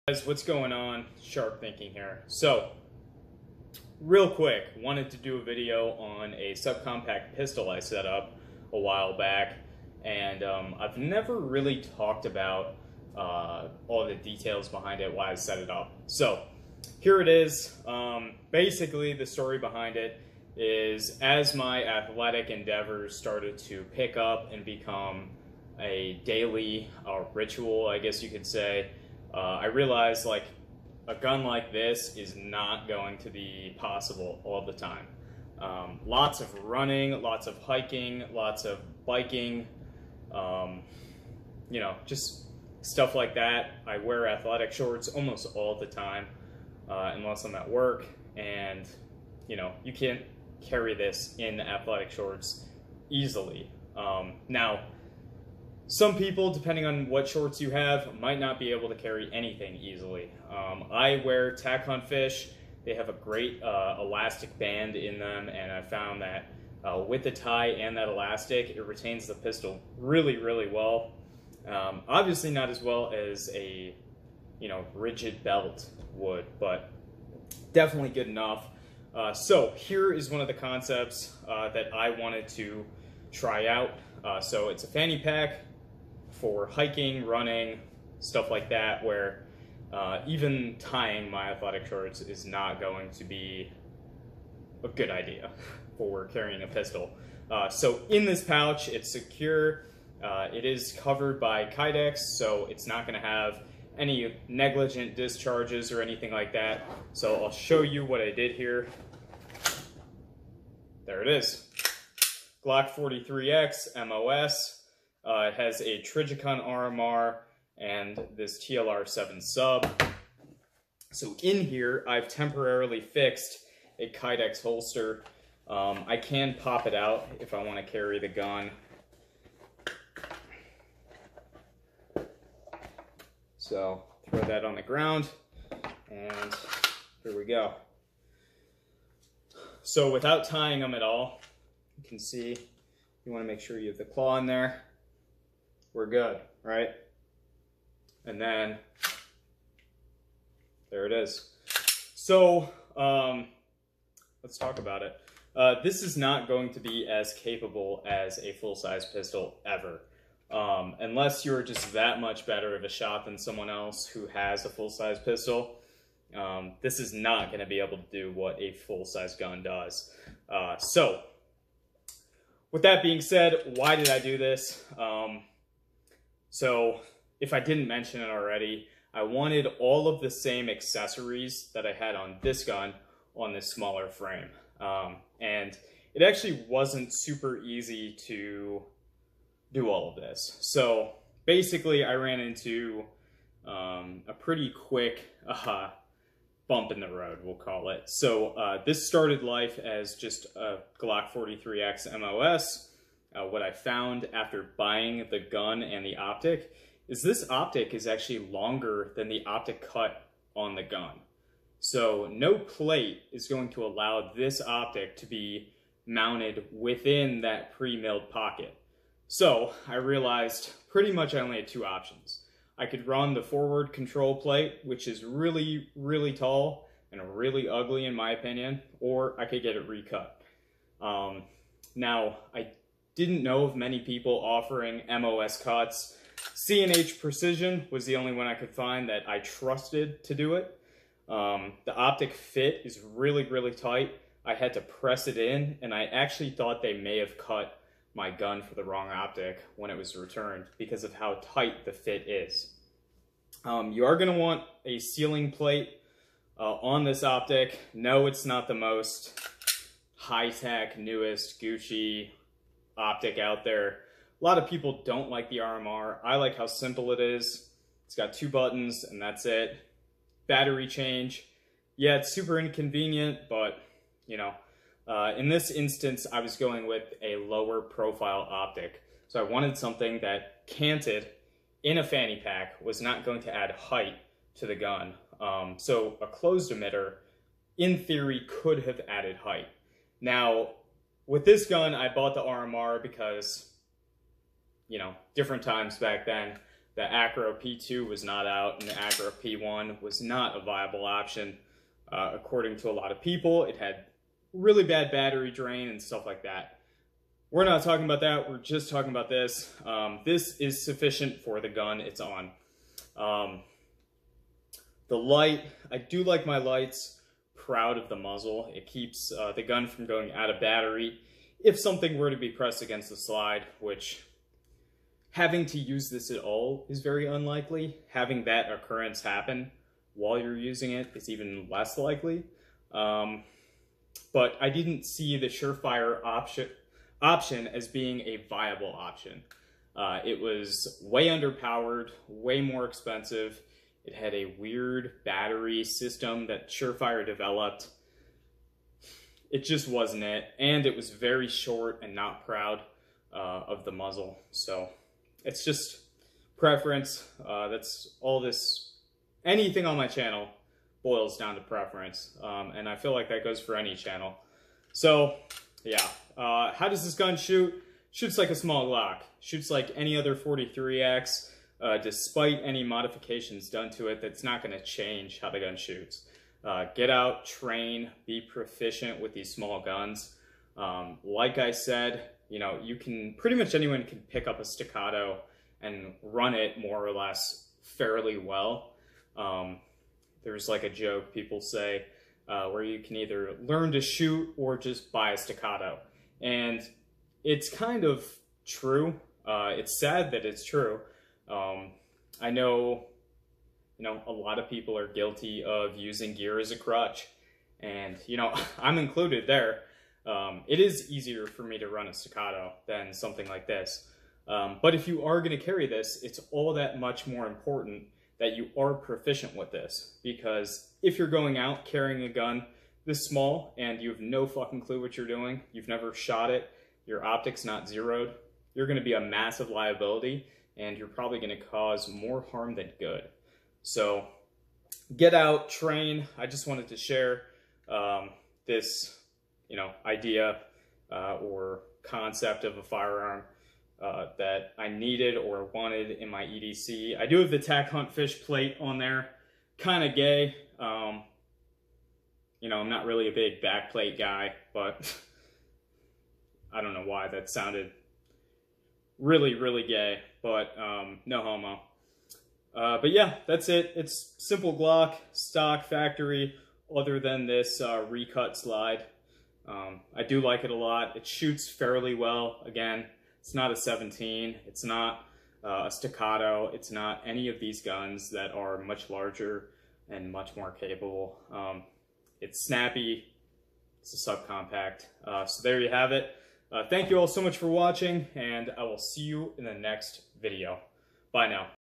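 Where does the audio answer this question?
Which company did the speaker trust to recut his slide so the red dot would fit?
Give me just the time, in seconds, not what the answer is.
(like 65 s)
236 s.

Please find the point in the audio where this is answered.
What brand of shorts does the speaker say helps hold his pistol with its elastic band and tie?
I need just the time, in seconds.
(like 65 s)
61 s.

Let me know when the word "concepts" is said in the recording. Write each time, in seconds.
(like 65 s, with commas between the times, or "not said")
80 s, 442 s.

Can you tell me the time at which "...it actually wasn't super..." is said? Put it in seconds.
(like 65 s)
186 s.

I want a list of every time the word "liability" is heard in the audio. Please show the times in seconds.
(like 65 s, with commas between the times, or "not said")
429 s.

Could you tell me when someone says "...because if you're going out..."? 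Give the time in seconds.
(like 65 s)
420 s.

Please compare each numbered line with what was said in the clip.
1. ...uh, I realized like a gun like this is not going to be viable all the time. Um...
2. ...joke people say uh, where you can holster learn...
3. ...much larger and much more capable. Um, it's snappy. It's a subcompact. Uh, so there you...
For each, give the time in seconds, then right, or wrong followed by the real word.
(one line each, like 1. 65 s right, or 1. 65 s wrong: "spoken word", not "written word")
1. 29 s wrong: "possible", not "viable"
2. 390 s wrong: "either", not "holster"
3. 478 s right.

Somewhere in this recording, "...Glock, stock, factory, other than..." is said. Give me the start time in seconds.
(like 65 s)
464 s.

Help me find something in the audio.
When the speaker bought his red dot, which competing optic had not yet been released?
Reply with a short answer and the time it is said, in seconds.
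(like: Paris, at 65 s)
Acro P2, at 297 s.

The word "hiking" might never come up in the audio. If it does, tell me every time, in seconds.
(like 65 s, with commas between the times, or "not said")
37 s, 86 s.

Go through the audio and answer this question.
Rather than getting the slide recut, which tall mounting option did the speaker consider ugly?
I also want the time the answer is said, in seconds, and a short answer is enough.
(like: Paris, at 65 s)
forward control plate, at 223 s.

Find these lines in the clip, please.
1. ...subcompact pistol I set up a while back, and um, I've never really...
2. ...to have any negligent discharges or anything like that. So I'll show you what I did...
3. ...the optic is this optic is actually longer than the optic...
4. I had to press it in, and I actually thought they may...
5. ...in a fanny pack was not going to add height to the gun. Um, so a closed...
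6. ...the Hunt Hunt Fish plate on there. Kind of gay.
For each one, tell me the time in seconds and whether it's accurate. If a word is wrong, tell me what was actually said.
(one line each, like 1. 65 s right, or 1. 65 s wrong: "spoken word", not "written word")
1. 6 s right
2. 103 s right
3. 206 s right
4. 244 s right
5. 281 s right
6. 447 s wrong: "Tack", not "Hunt".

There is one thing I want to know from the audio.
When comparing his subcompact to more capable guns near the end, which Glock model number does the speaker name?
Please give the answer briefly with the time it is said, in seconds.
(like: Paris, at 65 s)
17, at 473 s.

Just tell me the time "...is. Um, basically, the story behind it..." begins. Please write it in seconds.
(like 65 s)
17 s.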